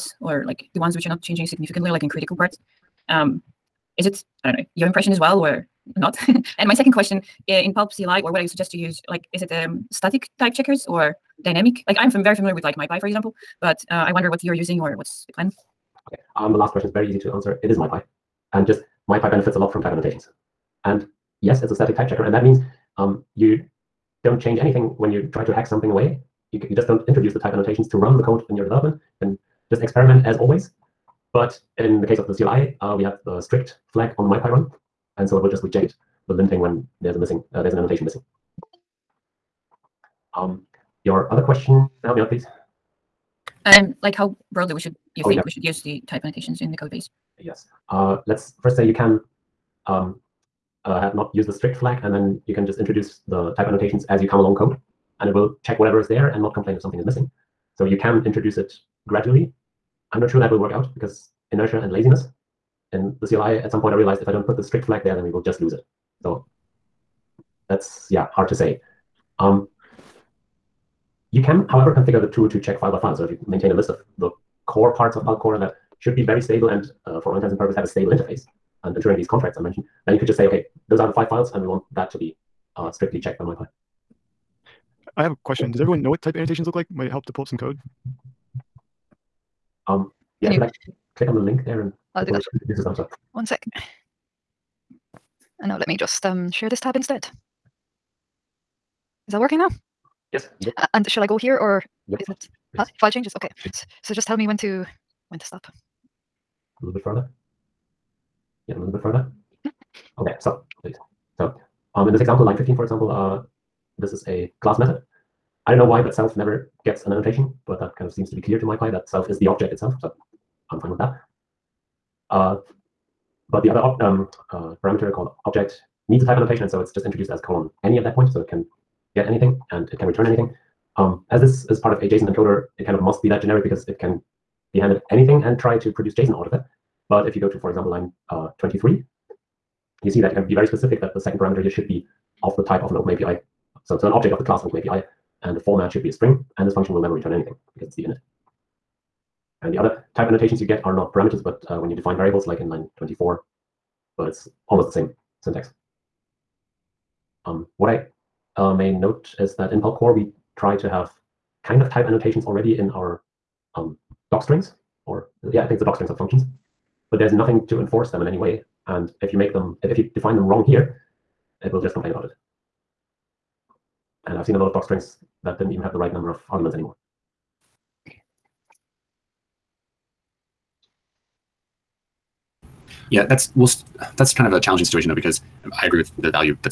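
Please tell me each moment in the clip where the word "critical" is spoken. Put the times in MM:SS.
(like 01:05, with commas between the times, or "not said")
00:02.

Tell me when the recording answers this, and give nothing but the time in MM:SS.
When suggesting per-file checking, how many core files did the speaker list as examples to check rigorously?
01:21.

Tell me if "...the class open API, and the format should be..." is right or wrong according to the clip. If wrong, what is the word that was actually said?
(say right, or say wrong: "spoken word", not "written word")
right.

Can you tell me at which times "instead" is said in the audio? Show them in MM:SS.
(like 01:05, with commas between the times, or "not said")
01:36.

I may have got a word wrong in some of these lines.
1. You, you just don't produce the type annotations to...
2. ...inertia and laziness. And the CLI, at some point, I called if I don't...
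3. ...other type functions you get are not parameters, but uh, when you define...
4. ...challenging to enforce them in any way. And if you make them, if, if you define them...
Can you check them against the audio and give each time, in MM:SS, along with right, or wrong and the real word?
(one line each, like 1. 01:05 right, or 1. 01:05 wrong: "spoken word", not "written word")
1. 00:26 wrong: "introduce", not "produce"
2. 01:01 wrong: "realized", not "called"
3. 02:29 wrong: "annotations", not "functions"
4. 02:47 wrong: "nothing", not "challenging".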